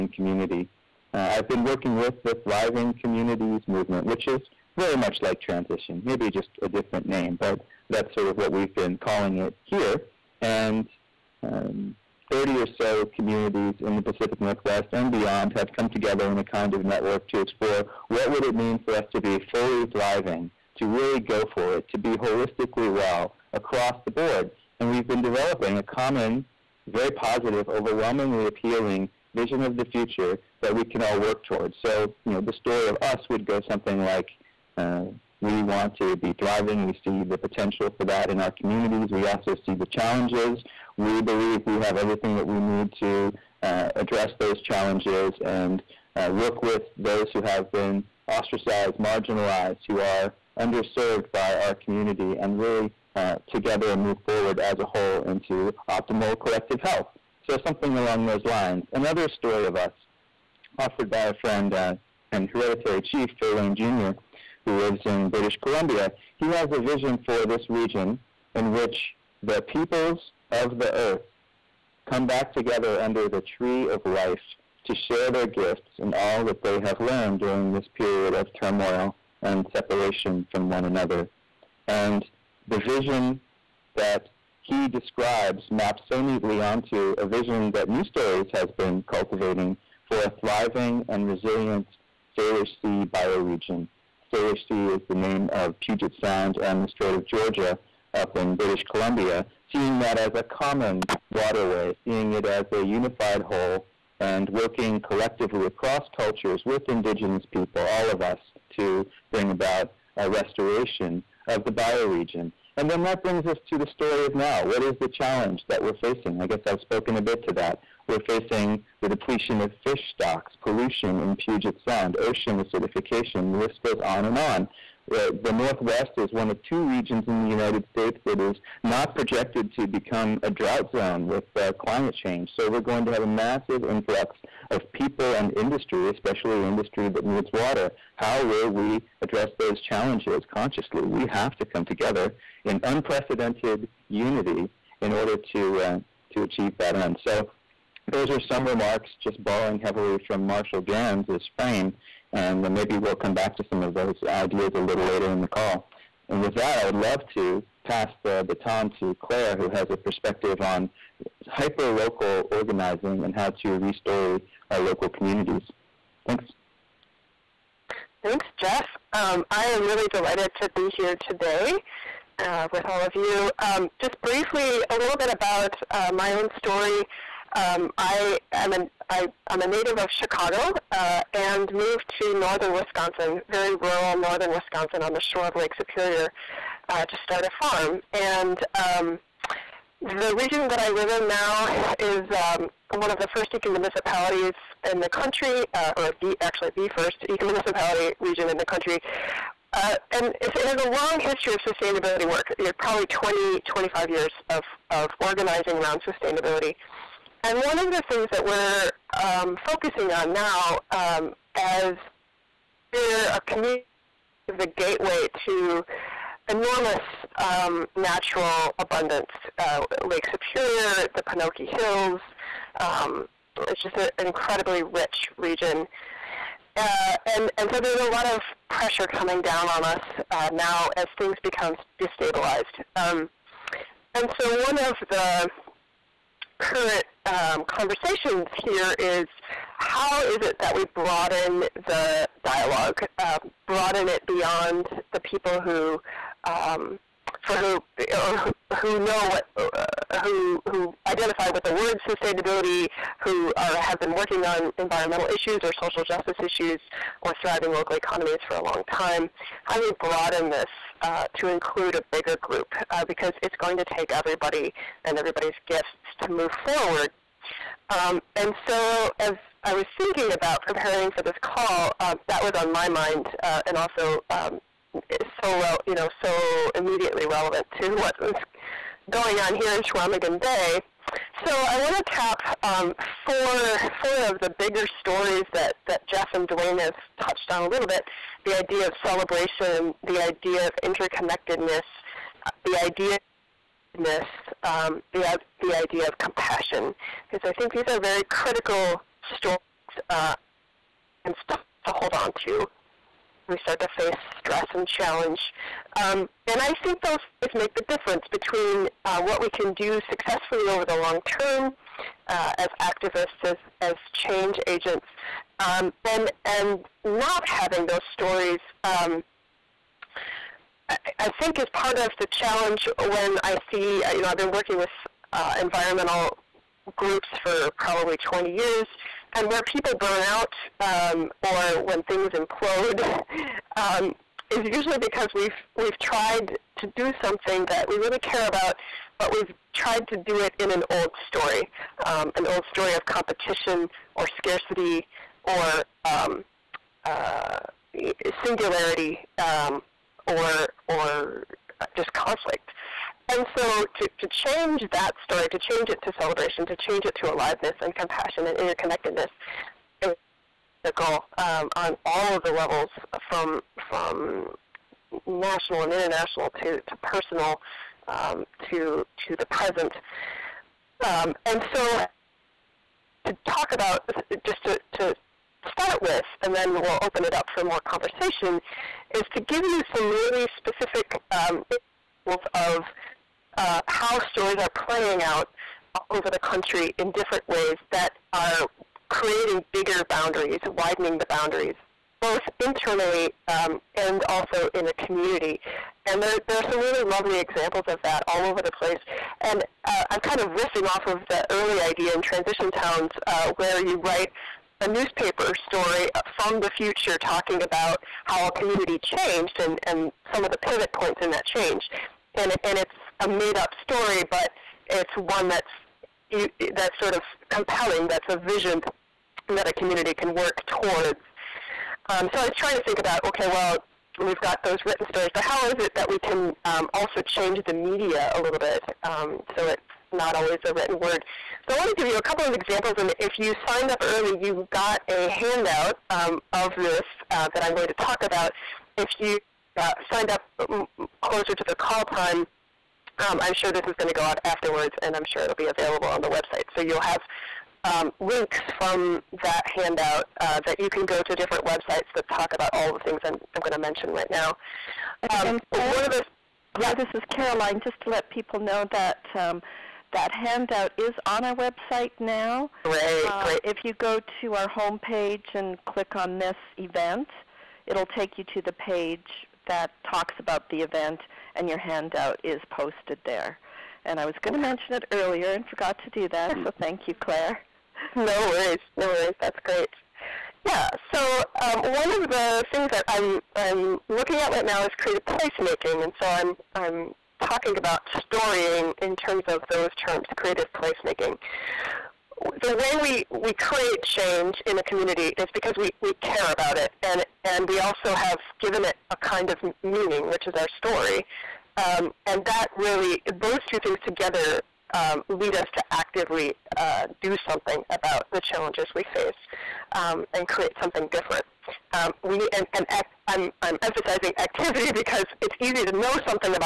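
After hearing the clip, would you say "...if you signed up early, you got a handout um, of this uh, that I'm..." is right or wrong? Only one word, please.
right.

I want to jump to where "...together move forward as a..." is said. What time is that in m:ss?
0:53.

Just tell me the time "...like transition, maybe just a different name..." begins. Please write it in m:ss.
0:05.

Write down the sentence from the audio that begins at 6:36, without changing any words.
And there, there are some really lovely examples of that all over the place.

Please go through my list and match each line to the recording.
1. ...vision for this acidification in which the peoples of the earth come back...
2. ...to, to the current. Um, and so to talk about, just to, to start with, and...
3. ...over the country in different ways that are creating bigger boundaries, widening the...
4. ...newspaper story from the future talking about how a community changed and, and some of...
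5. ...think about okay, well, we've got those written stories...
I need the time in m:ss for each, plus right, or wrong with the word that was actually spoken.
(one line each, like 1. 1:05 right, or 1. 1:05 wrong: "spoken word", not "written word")
1. 1:06 wrong: "region", not "acidification"
2. 6:08 wrong: "present", not "current"
3. 6:26 right
4. 6:44 right
5. 7:02 right.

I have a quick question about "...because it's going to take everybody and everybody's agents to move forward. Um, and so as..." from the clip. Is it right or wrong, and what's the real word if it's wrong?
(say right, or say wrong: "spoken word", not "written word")
wrong: "gifts", not "agents".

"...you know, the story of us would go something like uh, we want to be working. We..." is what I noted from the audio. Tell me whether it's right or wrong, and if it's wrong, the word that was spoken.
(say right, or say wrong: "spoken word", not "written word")
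wrong: "thriving", not "working".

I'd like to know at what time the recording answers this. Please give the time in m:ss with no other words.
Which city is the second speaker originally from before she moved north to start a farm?
3:00.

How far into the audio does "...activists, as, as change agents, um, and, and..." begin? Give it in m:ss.
5:12.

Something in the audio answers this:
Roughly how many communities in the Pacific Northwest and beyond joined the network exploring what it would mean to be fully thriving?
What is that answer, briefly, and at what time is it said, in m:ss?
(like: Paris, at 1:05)
30, at 0:12.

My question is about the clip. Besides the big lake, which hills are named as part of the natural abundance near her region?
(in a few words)
Penokee Hills.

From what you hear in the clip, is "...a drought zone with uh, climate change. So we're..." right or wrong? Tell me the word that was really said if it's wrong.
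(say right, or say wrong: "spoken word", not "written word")
right.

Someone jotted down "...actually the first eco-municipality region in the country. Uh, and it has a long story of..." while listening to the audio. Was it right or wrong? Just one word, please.
wrong.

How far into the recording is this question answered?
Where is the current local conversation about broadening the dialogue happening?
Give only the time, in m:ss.
4:39.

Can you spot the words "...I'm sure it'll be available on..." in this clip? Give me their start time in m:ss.
7:25.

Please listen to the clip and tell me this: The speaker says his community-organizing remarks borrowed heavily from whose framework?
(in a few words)
Marshall Ganz.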